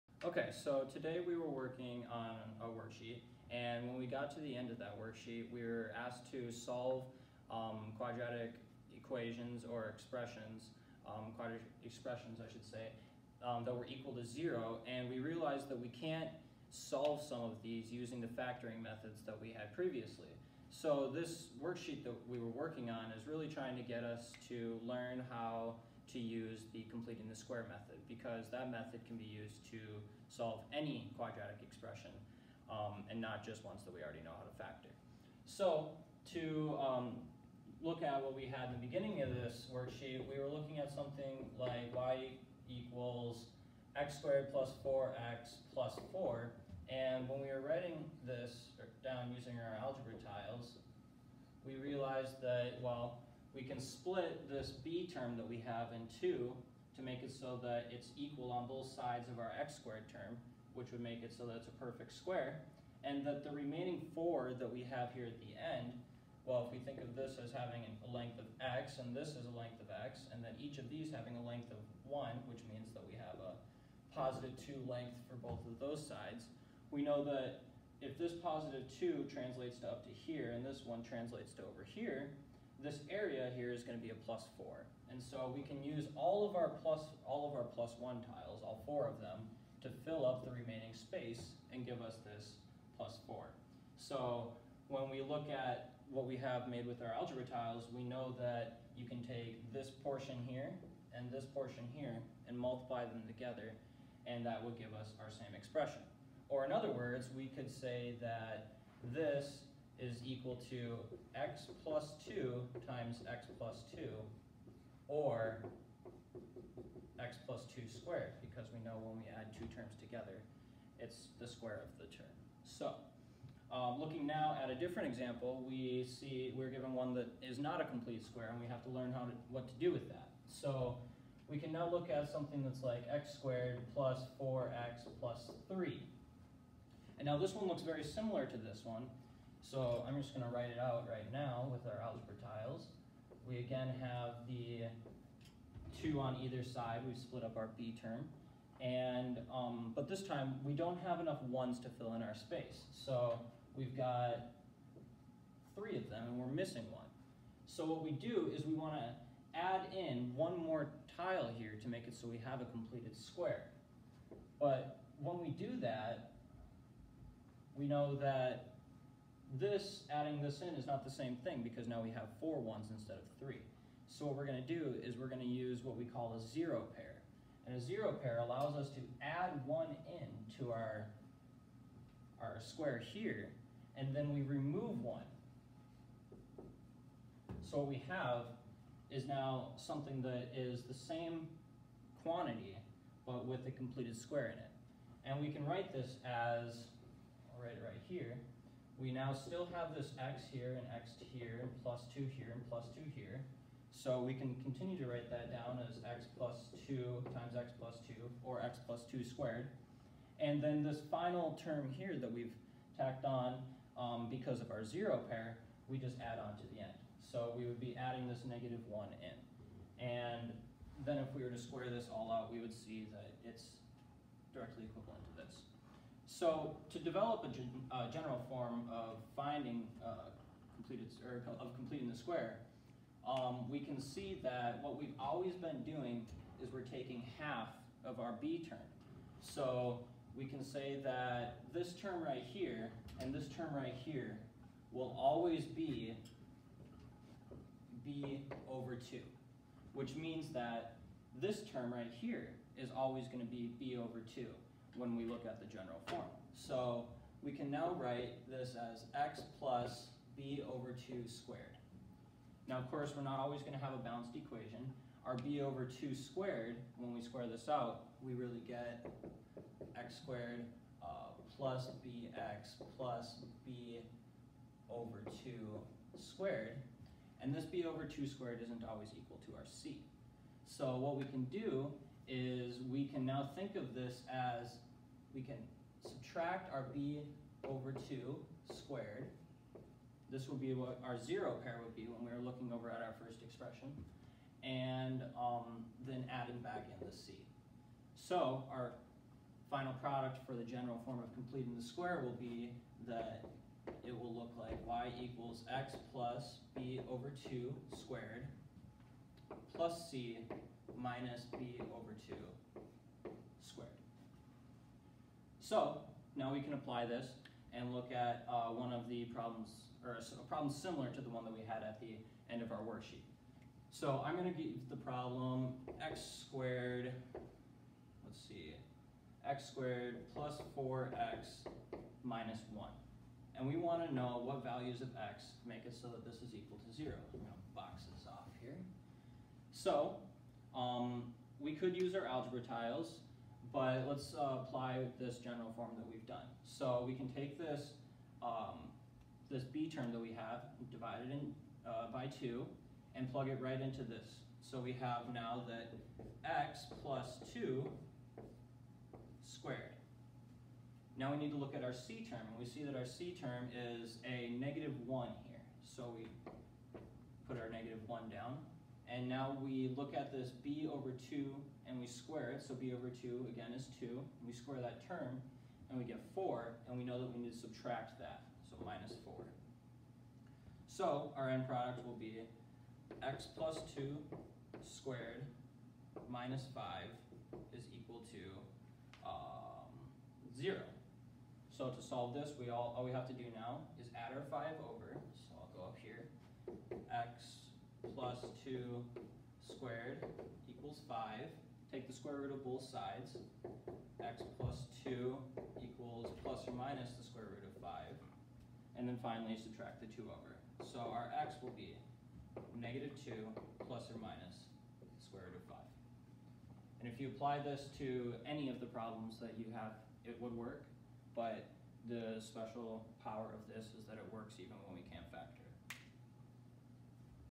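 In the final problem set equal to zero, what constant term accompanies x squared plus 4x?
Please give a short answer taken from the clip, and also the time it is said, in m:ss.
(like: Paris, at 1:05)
-1, at 5:32.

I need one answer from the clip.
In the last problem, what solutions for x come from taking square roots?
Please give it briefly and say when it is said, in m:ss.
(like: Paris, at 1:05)
-2 ± √5, at 6:52.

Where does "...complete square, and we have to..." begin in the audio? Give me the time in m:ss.
2:07.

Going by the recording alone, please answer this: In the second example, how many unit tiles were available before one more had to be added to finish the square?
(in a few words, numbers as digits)
3.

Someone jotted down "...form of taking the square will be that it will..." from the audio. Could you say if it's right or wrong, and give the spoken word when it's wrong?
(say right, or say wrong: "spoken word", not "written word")
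wrong: "completing", not "taking".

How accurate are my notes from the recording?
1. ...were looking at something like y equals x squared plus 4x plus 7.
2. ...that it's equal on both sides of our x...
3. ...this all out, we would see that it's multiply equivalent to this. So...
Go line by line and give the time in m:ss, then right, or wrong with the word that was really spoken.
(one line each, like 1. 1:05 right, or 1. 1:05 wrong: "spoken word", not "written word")
1. 0:40 wrong: "4", not "7"
2. 0:57 right
3. 3:41 wrong: "directly", not "multiply".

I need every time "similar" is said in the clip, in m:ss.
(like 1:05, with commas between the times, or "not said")
2:18, 5:20.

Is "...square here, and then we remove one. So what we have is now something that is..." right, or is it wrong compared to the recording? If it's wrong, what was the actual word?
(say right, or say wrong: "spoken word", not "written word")
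right.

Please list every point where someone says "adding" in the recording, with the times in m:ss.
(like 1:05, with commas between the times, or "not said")
2:50, 3:37, 4:56.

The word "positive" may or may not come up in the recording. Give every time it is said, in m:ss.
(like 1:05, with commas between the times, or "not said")
1:14, 1:18.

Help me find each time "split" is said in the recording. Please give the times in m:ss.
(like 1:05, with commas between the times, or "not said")
0:53, 2:27.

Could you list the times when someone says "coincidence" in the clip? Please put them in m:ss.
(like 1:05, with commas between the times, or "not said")
not said.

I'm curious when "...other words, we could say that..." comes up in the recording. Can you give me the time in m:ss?
1:46.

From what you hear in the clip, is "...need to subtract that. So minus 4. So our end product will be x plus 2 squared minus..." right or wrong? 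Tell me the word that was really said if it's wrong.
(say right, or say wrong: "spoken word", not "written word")
right.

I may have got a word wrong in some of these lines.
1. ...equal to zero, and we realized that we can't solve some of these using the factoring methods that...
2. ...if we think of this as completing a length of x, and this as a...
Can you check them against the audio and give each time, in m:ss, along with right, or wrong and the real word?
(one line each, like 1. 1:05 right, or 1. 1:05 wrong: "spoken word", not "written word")
1. 0:13 right
2. 1:06 wrong: "having", not "completing".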